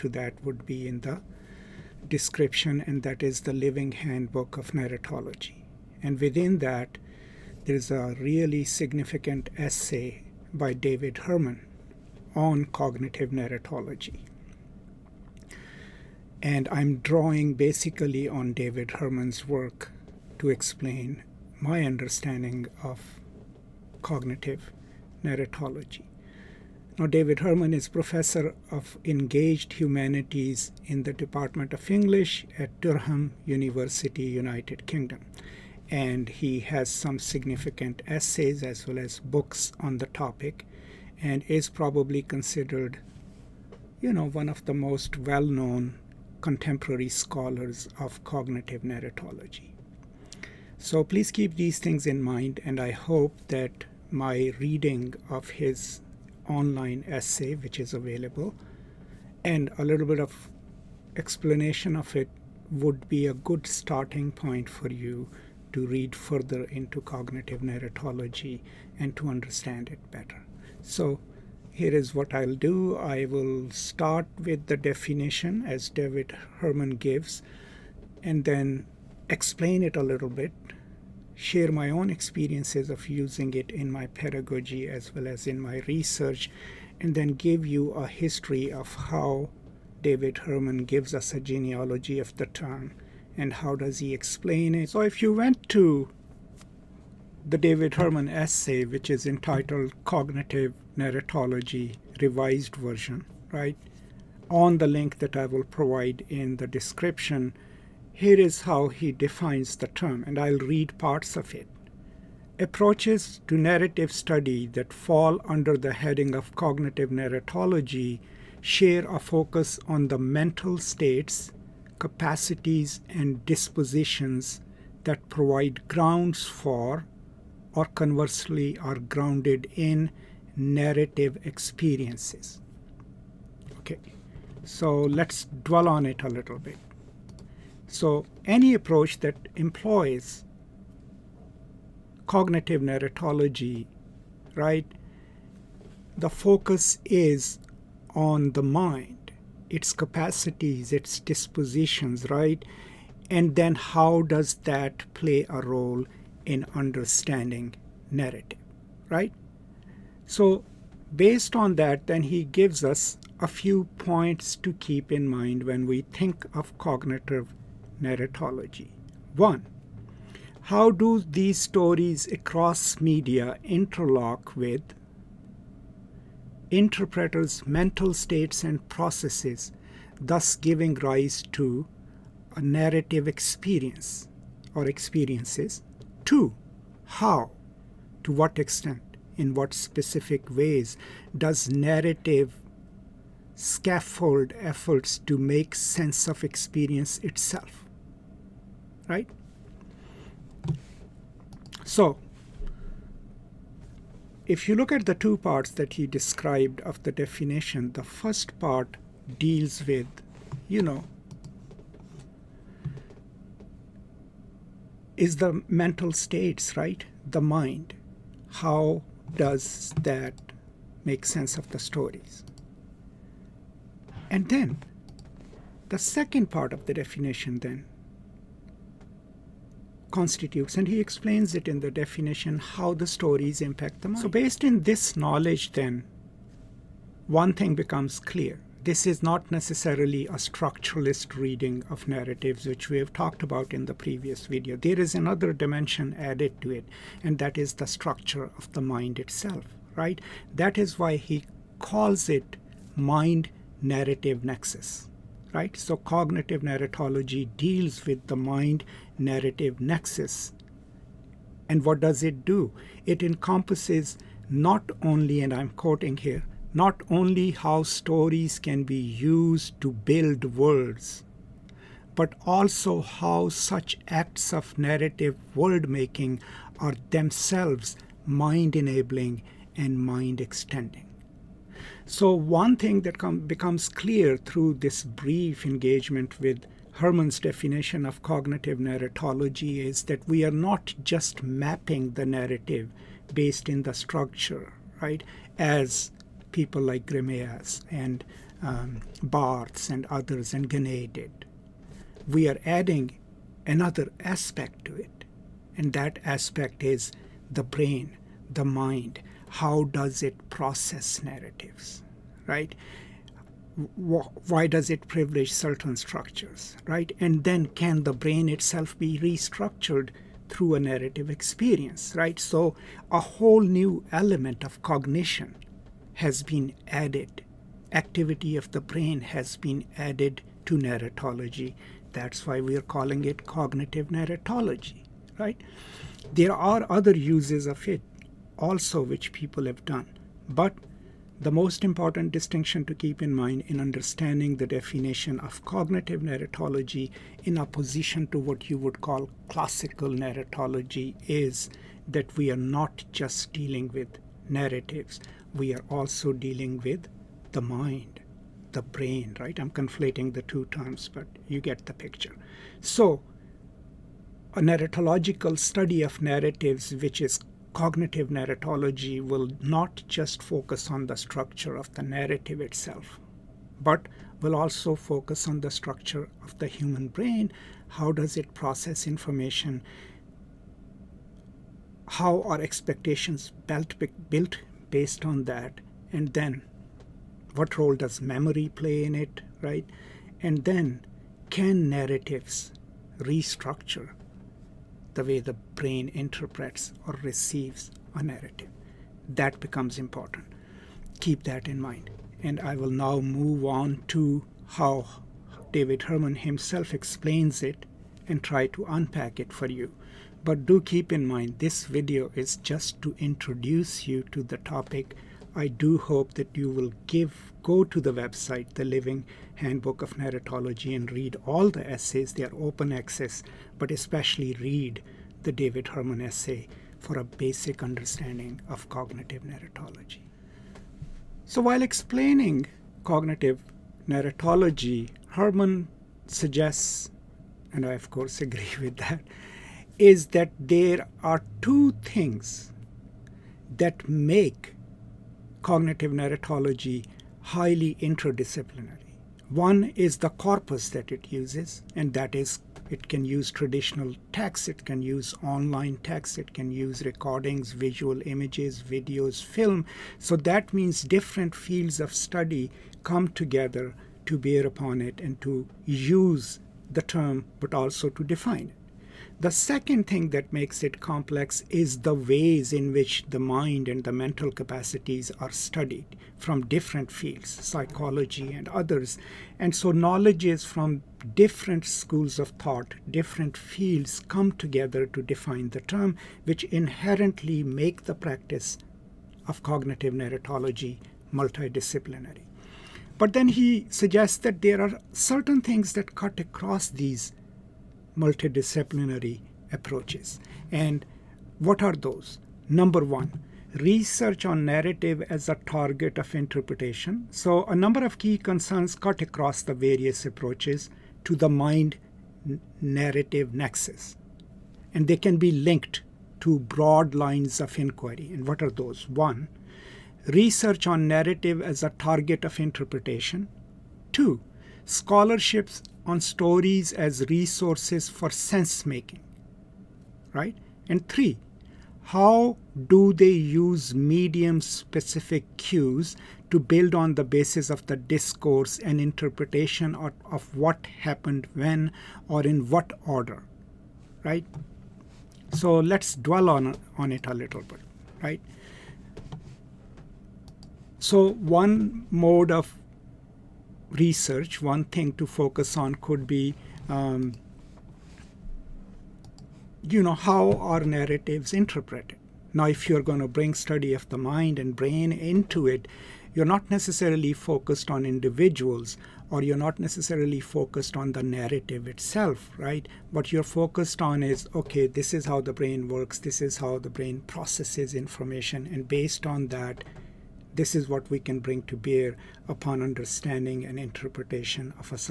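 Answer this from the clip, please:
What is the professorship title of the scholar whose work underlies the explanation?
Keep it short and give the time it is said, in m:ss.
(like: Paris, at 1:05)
Professor of engaged humanities, at 0:29.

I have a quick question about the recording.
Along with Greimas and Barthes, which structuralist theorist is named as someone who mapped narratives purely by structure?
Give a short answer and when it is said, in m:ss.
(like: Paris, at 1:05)
Genette, at 5:00.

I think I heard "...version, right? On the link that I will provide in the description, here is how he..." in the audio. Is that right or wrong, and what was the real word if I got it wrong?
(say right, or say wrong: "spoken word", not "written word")
right.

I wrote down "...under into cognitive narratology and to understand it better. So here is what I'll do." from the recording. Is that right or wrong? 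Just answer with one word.
wrong.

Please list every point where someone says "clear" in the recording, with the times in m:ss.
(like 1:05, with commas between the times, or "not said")
3:58, 4:43.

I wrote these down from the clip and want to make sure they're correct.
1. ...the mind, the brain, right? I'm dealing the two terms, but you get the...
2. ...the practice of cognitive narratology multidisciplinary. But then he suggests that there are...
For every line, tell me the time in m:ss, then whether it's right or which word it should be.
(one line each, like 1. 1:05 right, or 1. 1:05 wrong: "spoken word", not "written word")
1. 5:57 wrong: "conflating", not "dealing"
2. 8:08 right.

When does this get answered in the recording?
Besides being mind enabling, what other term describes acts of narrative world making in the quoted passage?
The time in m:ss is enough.
4:39.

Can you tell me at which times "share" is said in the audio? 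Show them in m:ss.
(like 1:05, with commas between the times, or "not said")
1:21, 1:58.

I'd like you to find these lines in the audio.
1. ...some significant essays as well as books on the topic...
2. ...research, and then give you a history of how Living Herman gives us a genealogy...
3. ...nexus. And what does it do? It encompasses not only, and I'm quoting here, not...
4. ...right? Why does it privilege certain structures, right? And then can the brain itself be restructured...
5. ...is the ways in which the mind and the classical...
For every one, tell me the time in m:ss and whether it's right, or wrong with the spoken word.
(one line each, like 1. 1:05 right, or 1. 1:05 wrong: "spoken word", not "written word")
1. 0:36 right
2. 1:25 wrong: "David", not "Living"
3. 4:19 right
4. 5:12 right
5. 7:51 wrong: "mental", not "classical".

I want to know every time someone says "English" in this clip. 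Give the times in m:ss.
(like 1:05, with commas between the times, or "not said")
0:31.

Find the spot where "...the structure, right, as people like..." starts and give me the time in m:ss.
4:53.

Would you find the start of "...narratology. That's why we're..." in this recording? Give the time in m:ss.
5:30.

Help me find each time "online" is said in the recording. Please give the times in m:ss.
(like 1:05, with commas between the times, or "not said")
0:56, 7:35.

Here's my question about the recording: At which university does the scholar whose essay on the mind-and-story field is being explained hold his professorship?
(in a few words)
Durham University.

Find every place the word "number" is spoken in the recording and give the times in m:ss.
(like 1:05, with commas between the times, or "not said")
8:22, 8:27.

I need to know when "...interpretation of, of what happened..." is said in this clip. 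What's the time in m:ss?
8:58.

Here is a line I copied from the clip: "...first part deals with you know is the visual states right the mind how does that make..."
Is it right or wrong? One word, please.
wrong.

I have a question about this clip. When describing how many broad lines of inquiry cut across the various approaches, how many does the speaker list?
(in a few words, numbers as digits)
3.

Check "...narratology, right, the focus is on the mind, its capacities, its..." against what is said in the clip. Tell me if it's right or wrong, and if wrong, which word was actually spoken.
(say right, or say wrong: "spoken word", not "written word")
right.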